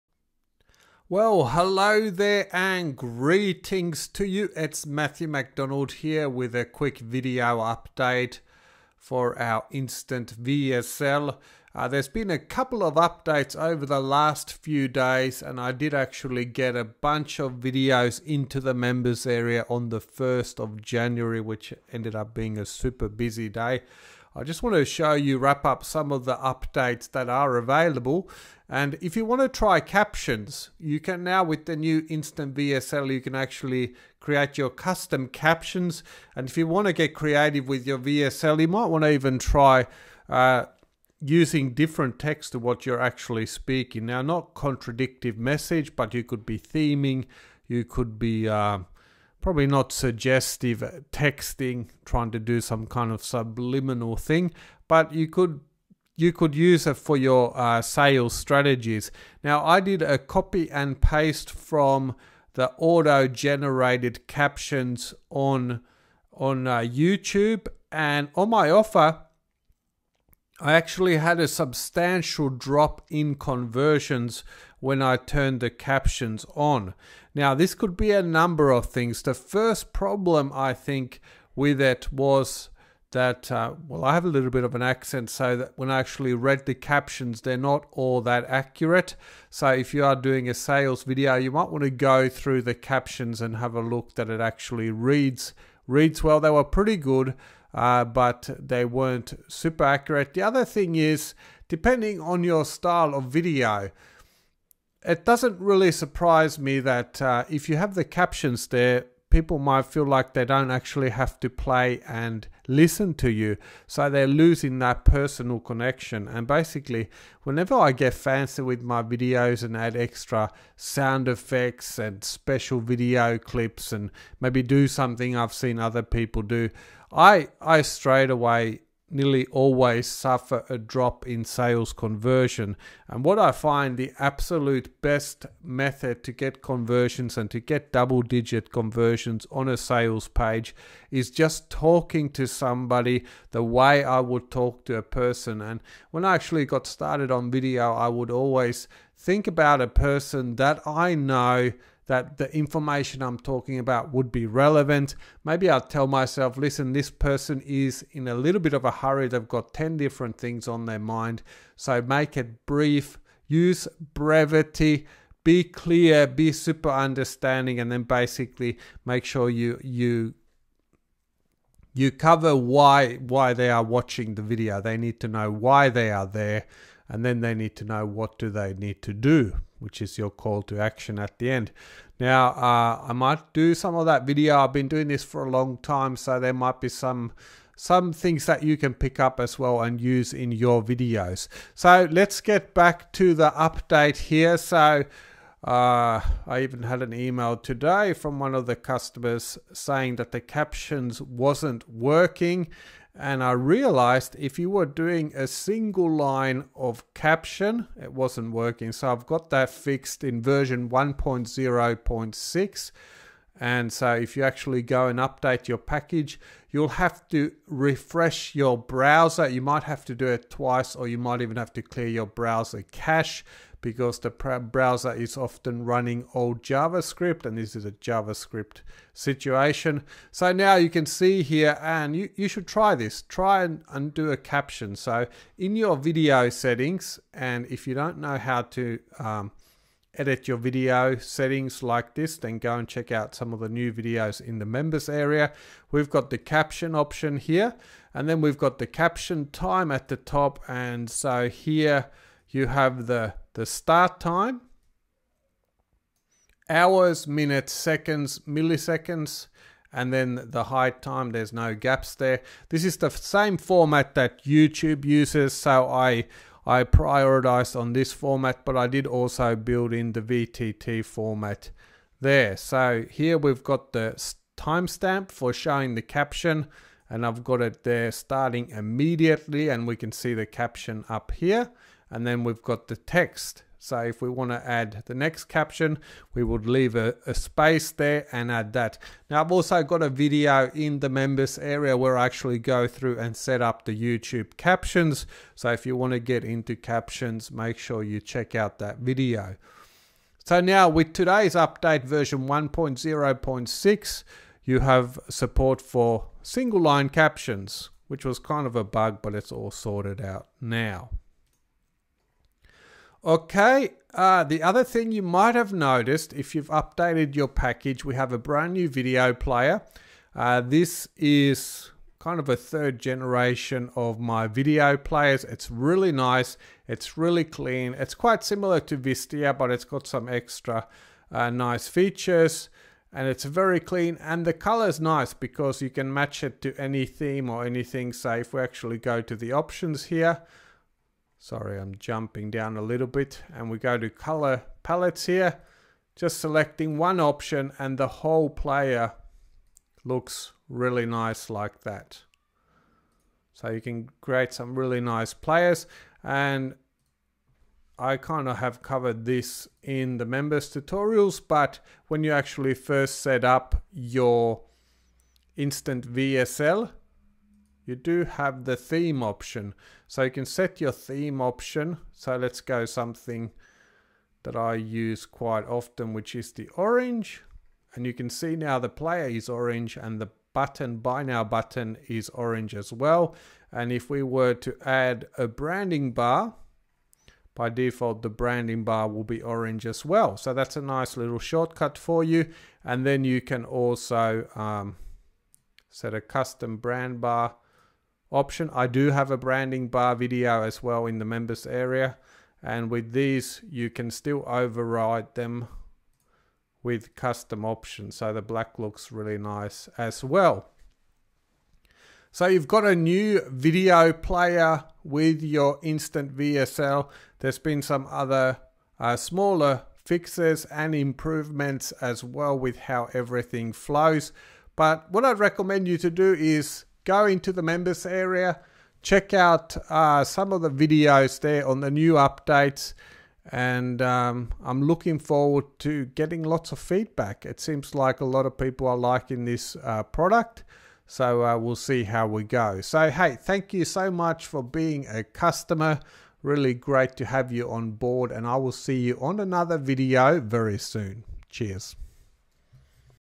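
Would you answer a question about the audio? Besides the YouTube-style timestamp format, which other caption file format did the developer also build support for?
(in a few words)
VTT.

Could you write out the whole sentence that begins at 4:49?
Now I've also got a video in the members area where I actually go through and set up the YouTube captions.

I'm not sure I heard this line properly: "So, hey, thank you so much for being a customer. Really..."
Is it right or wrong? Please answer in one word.
right.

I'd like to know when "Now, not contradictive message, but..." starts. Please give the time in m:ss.
0:44.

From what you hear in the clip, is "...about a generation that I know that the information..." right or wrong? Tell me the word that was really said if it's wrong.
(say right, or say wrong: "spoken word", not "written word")
wrong: "person", not "generation".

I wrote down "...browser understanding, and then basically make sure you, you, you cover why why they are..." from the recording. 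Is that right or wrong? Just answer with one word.
wrong.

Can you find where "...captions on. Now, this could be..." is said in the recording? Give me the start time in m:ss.
1:15.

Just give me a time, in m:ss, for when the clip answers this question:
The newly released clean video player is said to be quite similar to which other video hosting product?
5:28.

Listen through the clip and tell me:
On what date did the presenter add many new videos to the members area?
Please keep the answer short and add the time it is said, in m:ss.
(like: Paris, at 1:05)
1st of January, at 0:19.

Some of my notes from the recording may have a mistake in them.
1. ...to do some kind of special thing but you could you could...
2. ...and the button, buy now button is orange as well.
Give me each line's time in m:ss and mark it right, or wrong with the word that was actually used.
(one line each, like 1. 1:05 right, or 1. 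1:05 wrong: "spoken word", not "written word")
1. 0:52 wrong: "subliminal", not "special"
2. 6:19 right.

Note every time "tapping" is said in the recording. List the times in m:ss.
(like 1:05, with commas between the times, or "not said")
not said.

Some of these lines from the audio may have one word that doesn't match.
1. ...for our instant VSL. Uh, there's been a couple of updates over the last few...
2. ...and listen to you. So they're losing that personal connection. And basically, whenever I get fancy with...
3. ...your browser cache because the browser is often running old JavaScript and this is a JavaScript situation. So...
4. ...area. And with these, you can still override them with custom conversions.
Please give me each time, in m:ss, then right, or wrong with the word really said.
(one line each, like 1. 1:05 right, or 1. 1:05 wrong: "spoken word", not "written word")
1. 0:08 right
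2. 1:52 right
3. 3:42 right
4. 6:41 wrong: "options", not "conversions".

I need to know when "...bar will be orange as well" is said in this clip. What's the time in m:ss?
6:28.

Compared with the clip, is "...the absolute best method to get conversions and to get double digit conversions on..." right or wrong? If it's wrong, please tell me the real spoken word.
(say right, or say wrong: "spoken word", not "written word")
right.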